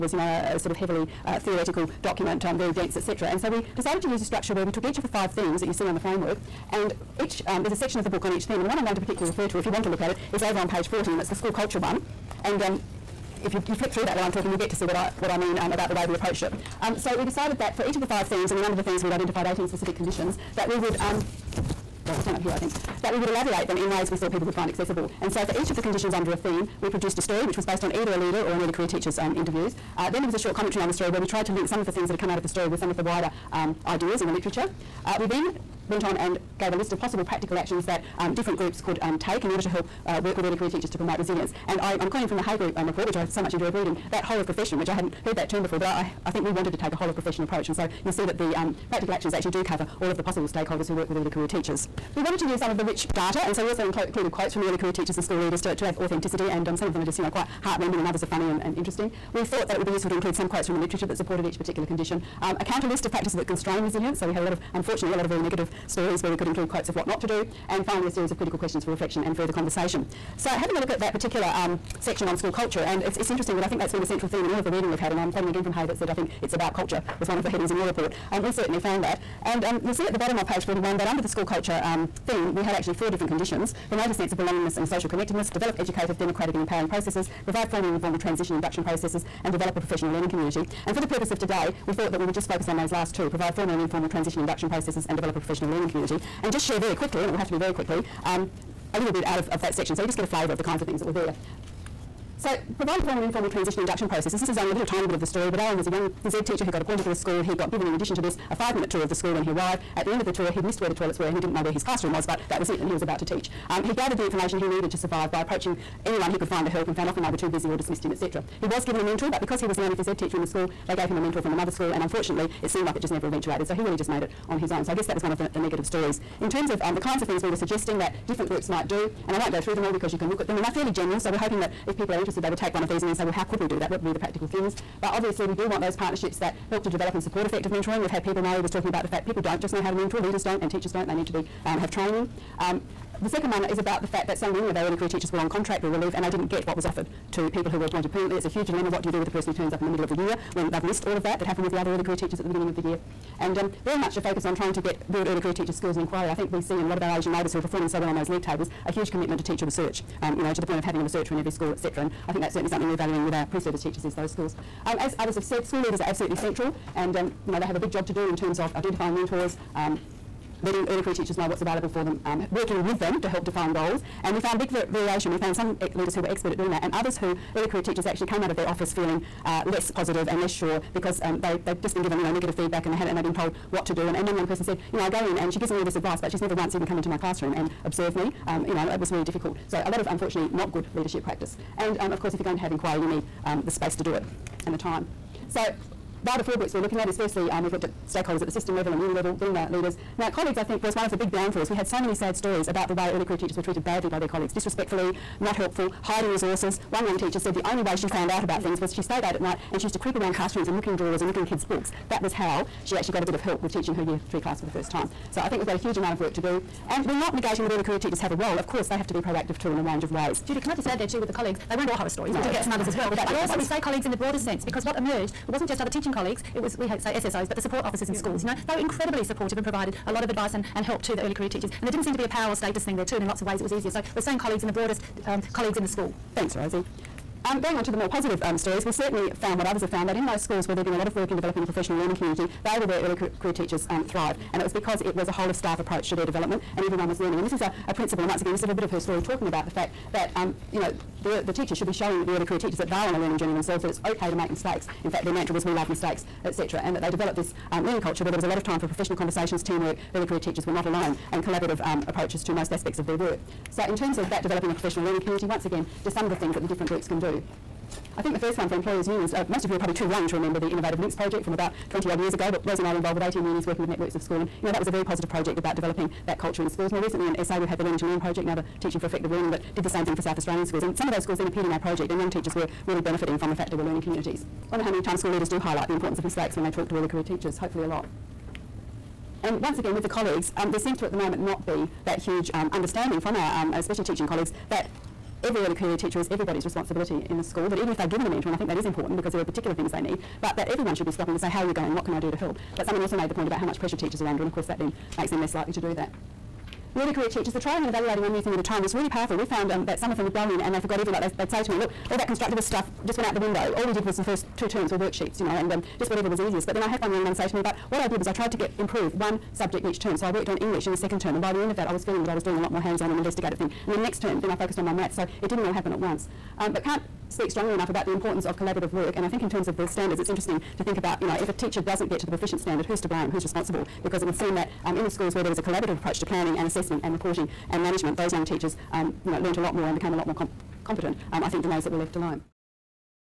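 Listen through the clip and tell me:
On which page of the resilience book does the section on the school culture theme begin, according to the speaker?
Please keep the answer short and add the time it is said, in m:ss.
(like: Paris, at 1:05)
40, at 0:10.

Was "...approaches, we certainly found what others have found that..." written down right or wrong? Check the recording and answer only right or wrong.
wrong.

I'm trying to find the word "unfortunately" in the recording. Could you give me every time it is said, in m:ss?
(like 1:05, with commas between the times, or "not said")
1:04, 2:02, 3:10.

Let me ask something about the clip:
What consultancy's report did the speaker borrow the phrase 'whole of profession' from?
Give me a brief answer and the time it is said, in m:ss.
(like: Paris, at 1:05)
Hay Group, at 0:42.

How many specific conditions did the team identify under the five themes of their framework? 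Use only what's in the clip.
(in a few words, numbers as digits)
18.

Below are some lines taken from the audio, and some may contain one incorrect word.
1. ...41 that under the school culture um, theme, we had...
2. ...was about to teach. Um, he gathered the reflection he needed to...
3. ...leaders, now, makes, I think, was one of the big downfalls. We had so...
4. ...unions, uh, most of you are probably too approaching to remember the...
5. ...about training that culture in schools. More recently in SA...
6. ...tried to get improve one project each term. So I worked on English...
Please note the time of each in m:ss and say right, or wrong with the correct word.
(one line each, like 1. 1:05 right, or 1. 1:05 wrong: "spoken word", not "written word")
1. 1:20 right
2. 1:52 wrong: "information", not "reflection"
3. 3:19 wrong: "colleagues", not "makes"
4. 4:29 wrong: "young", not "approaching"
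5. 4:35 wrong: "developing", not "training"
6. 5:18 wrong: "subject", not "project".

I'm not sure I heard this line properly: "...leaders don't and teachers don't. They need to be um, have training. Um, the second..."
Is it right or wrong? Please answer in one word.
right.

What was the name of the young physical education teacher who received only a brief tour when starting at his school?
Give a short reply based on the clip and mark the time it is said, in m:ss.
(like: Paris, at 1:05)
Aaron, at 1:45.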